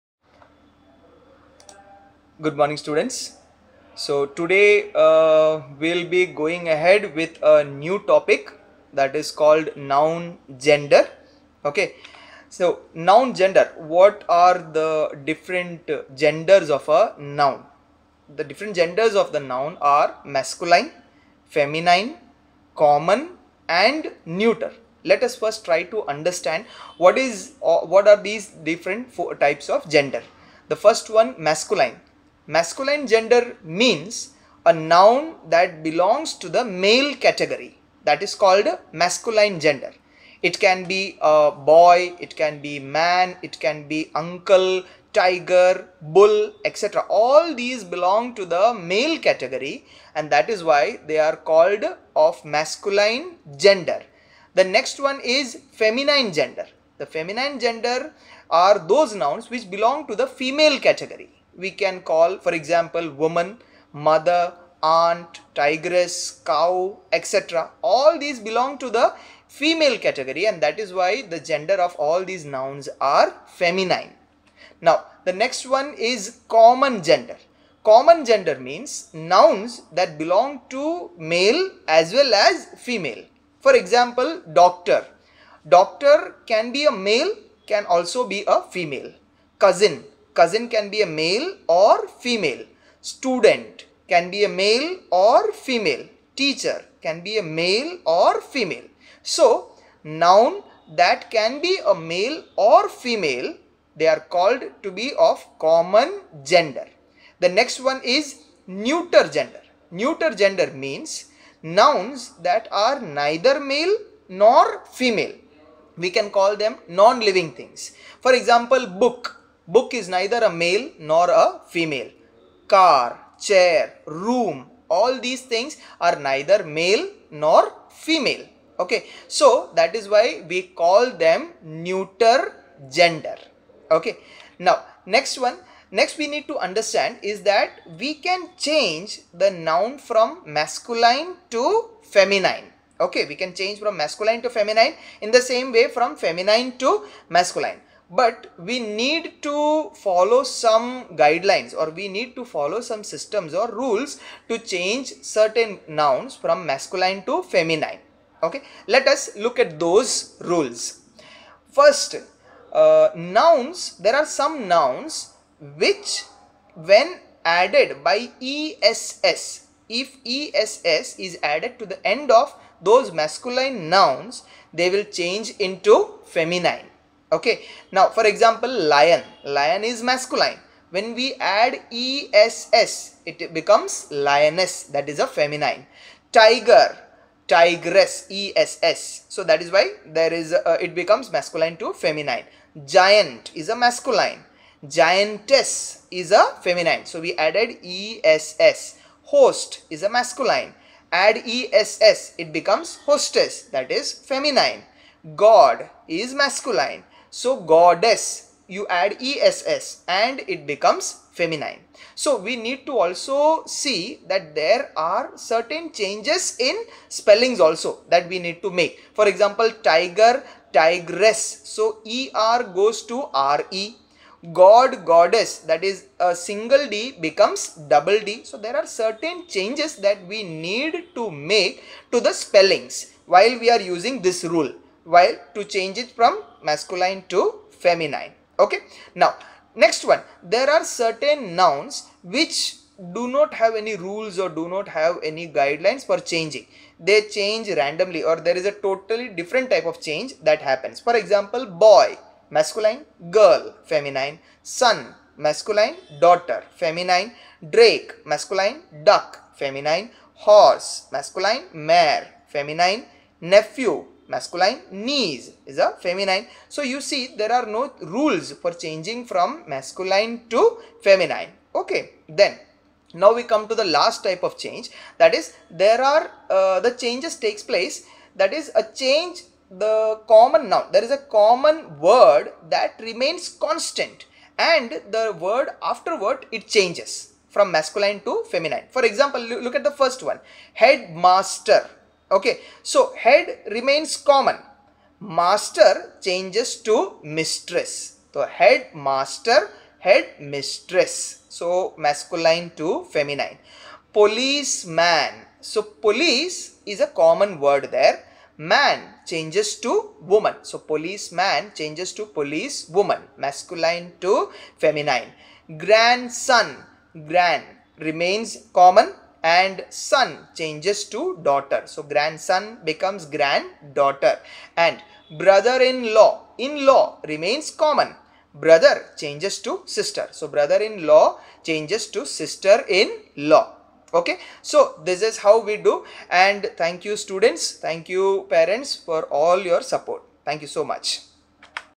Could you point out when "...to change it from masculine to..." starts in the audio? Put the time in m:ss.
3:55.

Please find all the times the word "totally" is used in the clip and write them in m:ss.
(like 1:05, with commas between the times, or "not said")
4:08.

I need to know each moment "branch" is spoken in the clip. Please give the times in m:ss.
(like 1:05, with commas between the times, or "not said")
not said.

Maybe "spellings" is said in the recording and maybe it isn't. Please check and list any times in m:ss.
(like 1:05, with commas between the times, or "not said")
3:37, 3:52.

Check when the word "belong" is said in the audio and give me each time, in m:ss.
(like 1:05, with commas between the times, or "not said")
0:35, 0:47, 0:59, 1:08, 1:20.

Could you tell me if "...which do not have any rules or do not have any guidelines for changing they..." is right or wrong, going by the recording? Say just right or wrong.
right.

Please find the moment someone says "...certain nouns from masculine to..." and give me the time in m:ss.
2:35.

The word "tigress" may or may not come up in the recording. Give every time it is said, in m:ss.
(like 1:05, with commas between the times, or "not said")
1:05, 3:07, 3:40.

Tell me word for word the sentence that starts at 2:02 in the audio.
Car, chair, room, all these things are neither male nor female.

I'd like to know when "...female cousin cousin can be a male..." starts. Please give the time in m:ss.
1:28.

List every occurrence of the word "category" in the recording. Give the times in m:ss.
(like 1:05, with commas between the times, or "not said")
0:37, 0:49, 1:00, 1:09.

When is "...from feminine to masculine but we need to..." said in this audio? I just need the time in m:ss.
2:25.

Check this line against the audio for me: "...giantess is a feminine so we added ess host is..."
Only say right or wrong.
right.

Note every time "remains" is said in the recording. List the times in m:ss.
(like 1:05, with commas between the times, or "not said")
4:43, 4:53, 5:17, 5:27.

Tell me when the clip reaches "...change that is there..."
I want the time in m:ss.
4:34.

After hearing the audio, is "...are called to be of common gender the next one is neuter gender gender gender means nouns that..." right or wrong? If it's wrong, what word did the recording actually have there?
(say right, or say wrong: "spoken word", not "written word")
wrong: "neuter", not "gender".